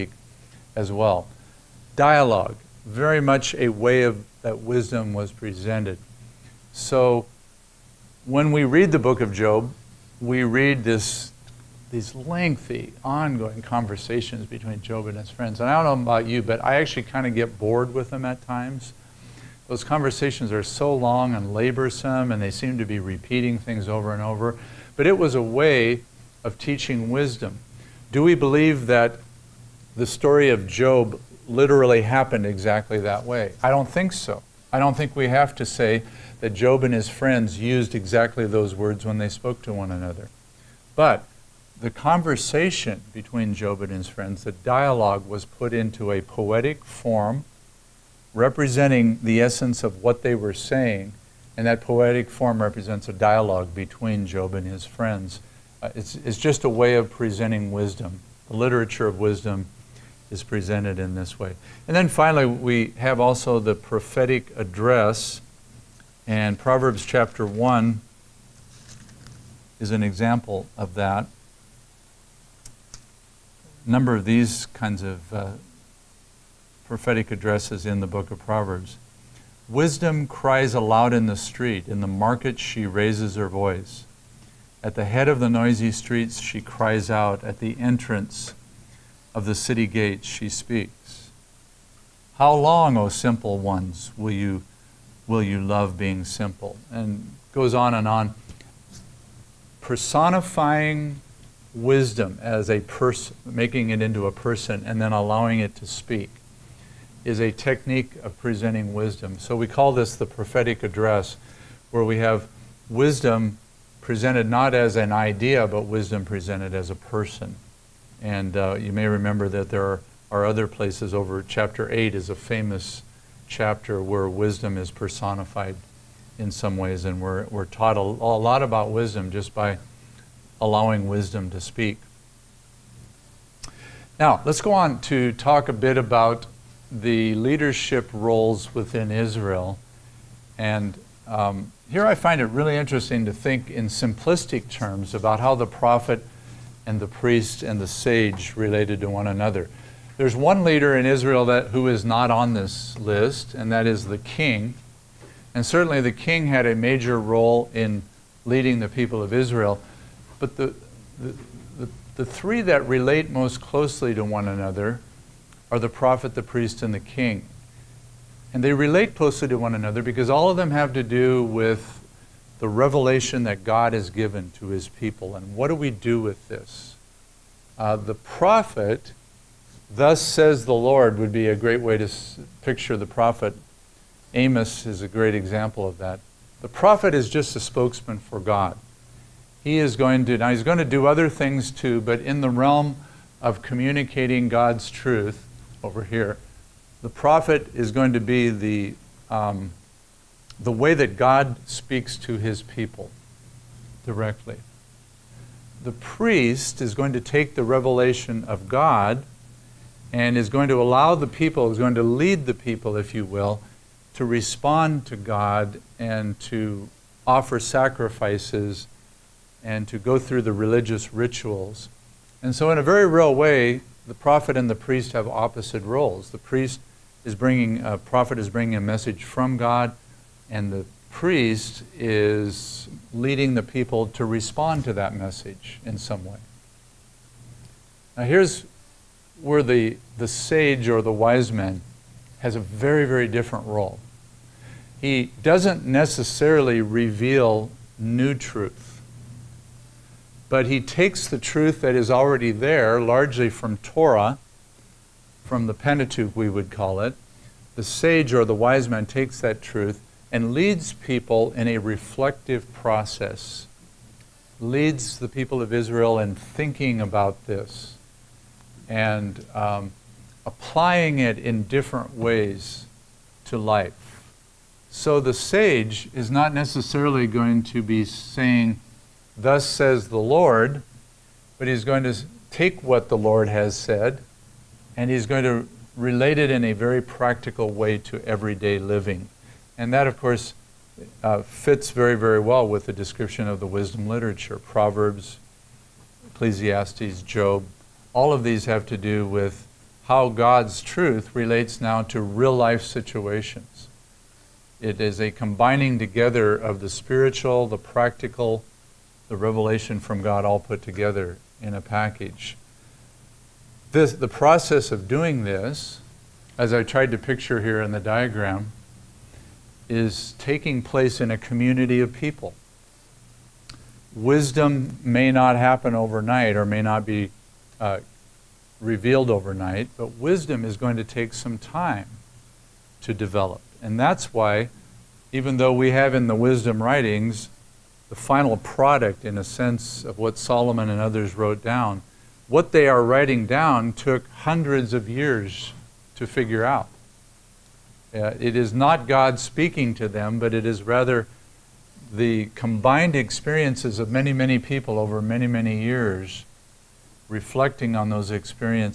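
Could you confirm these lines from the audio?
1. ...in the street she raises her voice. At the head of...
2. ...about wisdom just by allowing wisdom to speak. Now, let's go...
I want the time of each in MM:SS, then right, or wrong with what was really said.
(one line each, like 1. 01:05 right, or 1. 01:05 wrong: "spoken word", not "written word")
1. 01:21 wrong: "market", not "street"
2. 02:08 right.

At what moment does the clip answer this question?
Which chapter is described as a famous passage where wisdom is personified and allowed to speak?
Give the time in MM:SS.
02:01.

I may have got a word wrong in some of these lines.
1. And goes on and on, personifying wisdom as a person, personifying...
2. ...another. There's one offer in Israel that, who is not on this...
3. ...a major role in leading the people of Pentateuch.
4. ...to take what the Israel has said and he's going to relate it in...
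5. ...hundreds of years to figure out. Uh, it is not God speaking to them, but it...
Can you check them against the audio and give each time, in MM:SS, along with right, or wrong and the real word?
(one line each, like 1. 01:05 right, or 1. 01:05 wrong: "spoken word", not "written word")
1. 01:36 wrong: "making", not "personifying"
2. 02:29 wrong: "leader", not "offer"
3. 02:36 wrong: "Israel", not "Pentateuch"
4. 04:42 wrong: "Lord", not "Israel"
5. 05:44 right.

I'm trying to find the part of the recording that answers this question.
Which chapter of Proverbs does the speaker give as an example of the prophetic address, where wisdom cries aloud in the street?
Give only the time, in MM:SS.
01:06.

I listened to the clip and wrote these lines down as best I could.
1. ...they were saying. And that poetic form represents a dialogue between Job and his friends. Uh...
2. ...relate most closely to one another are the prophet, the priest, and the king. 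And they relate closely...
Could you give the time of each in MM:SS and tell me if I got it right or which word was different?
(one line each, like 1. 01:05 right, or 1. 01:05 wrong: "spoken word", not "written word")
1. 00:50 right
2. 02:42 right.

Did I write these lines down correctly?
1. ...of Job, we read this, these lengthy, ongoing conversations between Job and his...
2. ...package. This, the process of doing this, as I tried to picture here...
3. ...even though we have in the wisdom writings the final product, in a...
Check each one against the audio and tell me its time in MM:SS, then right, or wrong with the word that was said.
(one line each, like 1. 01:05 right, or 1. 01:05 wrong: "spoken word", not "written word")
1. 00:09 right
2. 05:11 right
3. 05:35 right.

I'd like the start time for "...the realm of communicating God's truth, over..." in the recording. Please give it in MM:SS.
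03:12.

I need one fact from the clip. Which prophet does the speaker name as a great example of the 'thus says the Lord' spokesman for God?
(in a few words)
Amos.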